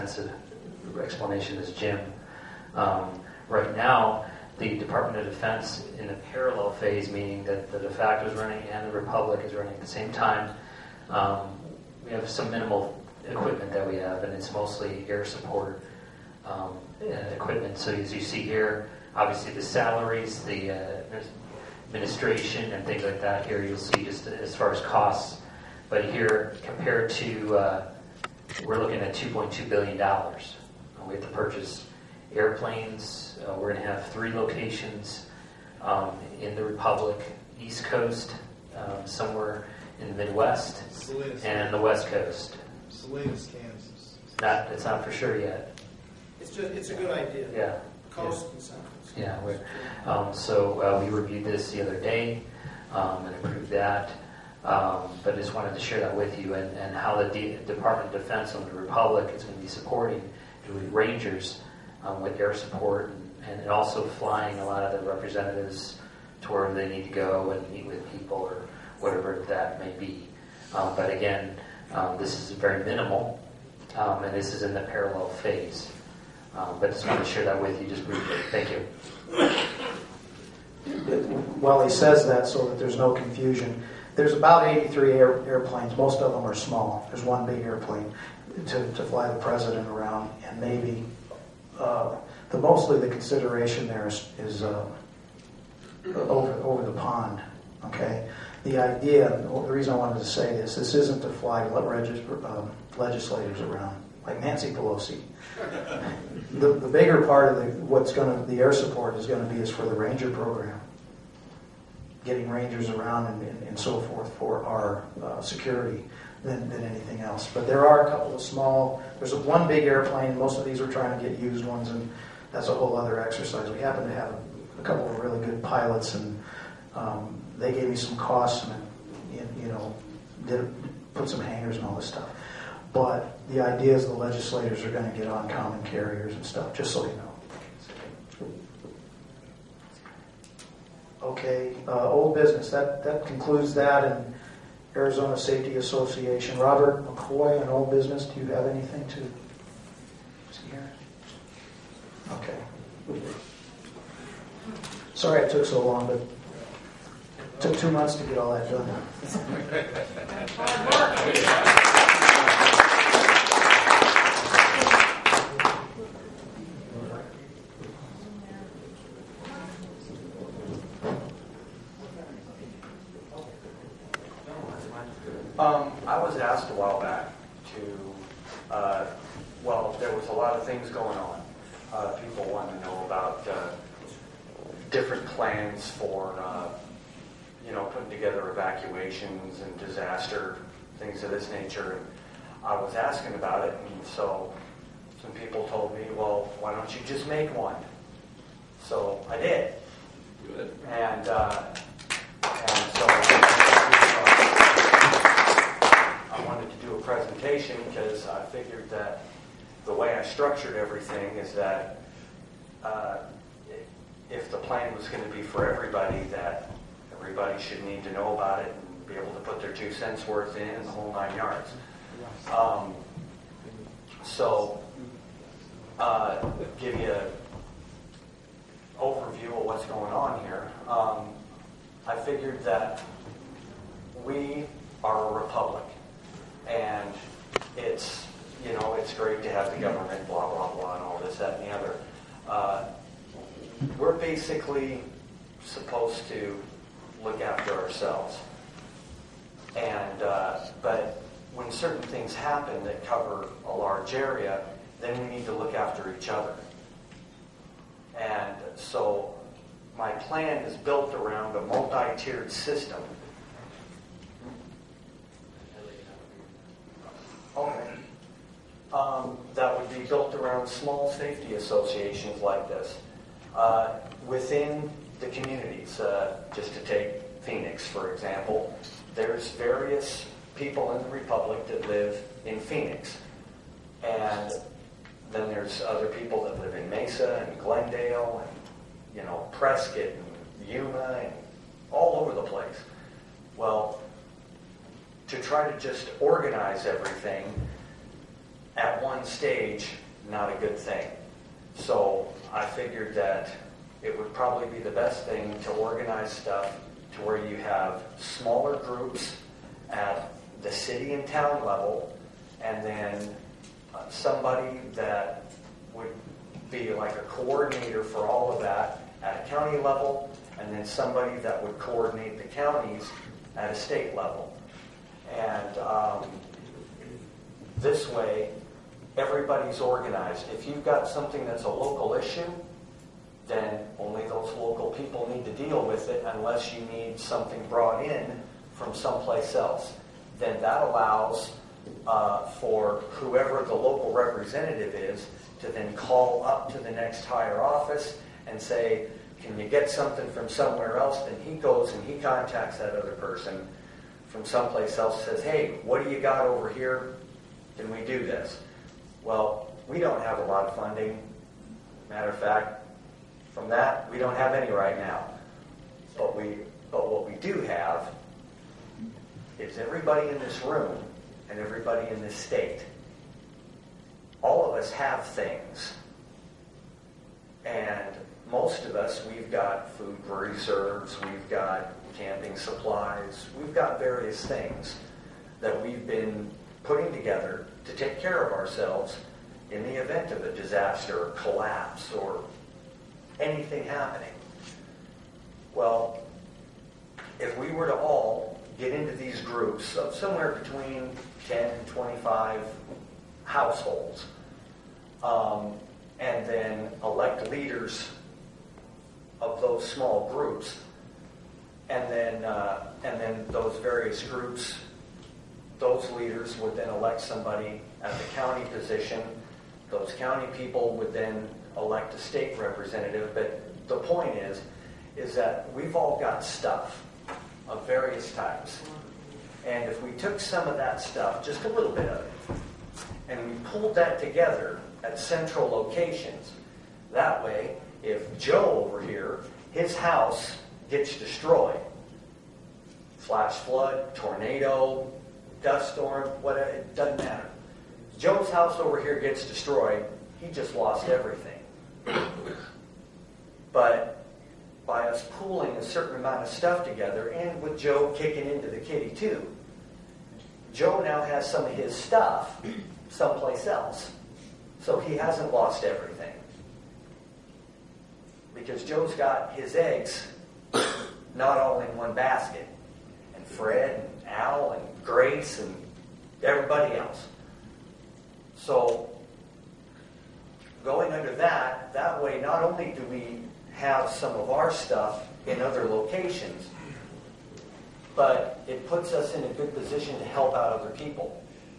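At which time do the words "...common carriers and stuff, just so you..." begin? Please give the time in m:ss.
2:15.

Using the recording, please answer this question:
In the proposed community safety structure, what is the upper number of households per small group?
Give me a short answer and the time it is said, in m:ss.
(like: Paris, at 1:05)
25, at 6:41.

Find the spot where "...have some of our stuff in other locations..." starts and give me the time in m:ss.
8:03.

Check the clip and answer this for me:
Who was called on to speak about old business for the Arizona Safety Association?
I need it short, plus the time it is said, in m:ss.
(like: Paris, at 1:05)
Robert McCoy, at 2:26.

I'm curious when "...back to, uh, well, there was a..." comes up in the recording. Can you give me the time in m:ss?
2:56.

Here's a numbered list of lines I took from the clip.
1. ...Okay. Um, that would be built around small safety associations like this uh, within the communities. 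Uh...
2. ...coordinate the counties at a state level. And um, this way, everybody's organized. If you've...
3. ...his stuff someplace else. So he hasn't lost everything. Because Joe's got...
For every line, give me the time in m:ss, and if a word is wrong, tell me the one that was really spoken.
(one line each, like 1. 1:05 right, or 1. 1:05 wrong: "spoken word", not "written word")
1. 4:27 right
2. 5:21 right
3. 7:41 right.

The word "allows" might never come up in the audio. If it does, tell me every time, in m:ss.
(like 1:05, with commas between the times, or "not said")
5:40.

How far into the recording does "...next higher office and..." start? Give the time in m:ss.
5:46.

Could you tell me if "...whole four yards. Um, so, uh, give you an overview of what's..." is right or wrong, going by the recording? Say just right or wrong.
wrong.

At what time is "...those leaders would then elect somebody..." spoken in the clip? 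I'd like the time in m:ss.
6:55.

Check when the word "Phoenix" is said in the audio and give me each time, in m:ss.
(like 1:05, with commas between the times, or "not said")
4:37, 4:42.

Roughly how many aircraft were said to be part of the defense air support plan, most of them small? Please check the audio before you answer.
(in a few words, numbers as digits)
83.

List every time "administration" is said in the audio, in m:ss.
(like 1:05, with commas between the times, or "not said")
0:21.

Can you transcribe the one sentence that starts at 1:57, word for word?
But there are a couple of small.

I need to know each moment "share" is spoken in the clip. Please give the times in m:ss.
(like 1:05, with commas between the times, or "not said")
0:55, 1:17.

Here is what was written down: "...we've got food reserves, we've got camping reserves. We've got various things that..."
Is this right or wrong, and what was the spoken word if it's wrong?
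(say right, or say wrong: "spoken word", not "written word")
wrong: "supplies", not "reserves".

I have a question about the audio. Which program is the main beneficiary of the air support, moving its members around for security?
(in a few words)
Ranger program.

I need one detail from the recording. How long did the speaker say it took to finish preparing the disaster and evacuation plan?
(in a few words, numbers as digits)
Two months.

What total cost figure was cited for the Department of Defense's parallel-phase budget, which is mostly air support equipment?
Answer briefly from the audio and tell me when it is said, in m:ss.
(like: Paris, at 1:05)
2.2 billion dollars, at 0:29.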